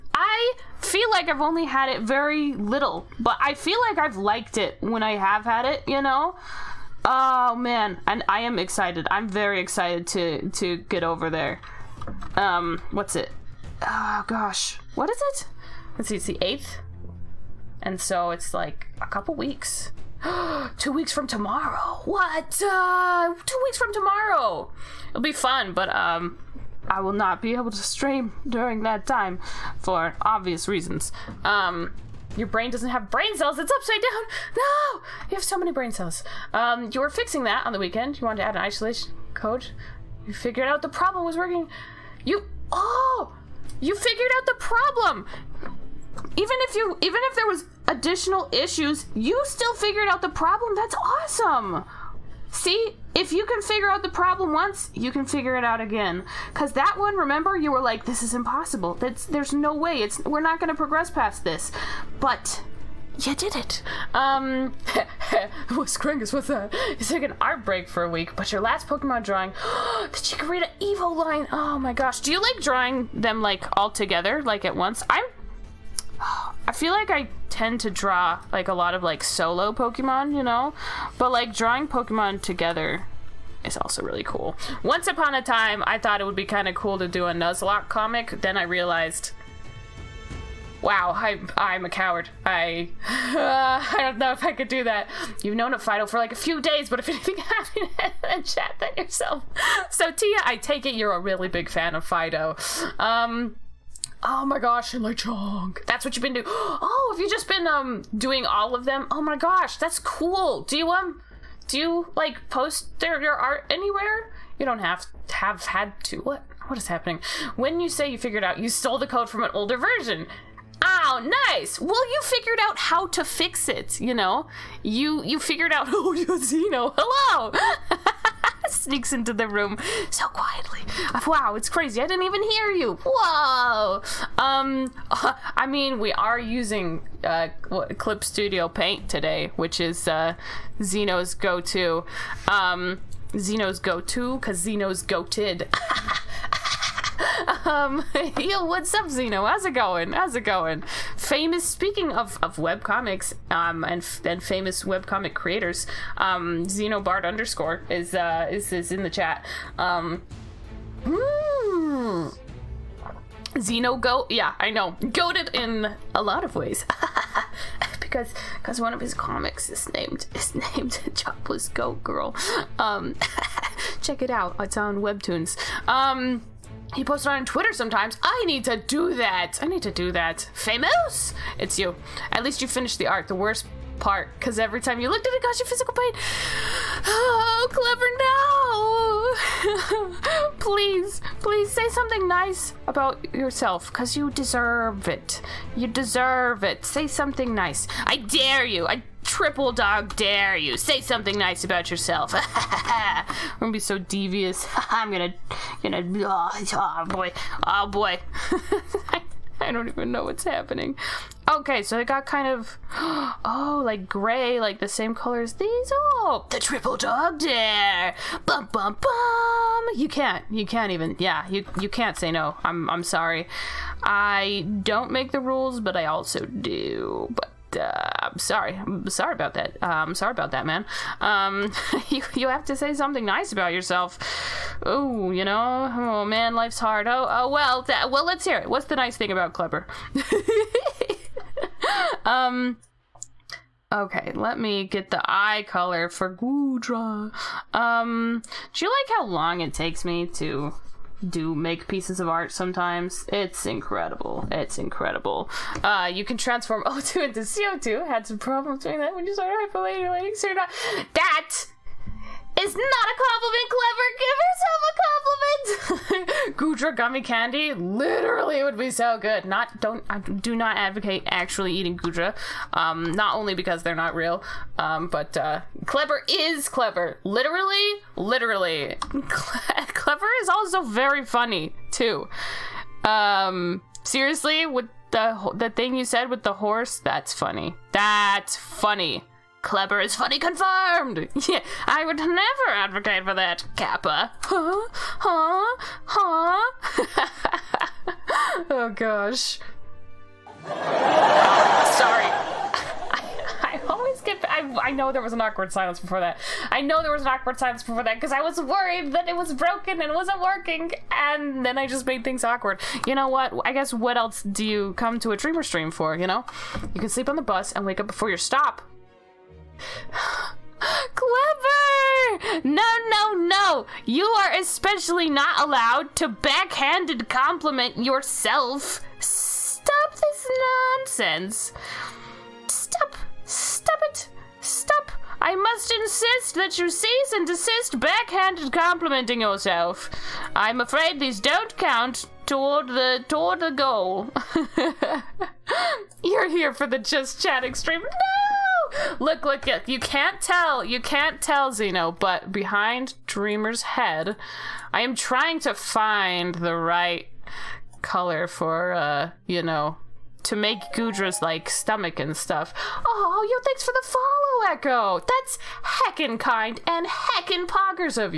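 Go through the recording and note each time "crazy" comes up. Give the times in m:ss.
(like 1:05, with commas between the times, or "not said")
2:11.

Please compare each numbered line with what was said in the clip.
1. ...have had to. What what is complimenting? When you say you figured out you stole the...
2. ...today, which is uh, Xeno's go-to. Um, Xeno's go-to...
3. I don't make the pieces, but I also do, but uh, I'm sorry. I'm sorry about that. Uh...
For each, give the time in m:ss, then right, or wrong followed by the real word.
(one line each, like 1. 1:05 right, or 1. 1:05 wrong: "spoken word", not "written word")
1. 1:55 wrong: "happening", not "complimenting"
2. 2:19 right
3. 3:44 wrong: "rules", not "pieces".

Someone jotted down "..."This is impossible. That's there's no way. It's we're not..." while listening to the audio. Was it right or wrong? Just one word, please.
right.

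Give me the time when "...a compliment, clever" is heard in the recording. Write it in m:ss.
4:23.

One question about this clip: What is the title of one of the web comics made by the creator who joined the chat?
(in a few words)
Jobless Goat Girl.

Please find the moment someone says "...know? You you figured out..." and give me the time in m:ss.
2:04.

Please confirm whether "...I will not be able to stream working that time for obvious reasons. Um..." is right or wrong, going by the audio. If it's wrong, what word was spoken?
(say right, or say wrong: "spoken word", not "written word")
wrong: "during", not "working".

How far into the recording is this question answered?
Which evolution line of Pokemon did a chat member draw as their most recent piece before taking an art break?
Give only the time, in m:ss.
1:10.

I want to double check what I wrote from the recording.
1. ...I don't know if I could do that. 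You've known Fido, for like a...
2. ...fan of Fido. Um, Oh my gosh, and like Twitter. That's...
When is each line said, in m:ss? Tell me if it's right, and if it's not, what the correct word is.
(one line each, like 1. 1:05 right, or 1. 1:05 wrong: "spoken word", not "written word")
1. 1:33 right
2. 1:41 wrong: "Chong", not "Twitter".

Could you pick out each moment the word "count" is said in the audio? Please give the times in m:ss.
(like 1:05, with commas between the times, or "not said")
5:41.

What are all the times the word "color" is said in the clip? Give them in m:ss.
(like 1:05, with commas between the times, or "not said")
3:35, 4:05, 5:58.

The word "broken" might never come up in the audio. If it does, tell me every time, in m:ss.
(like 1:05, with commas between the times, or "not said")
5:09.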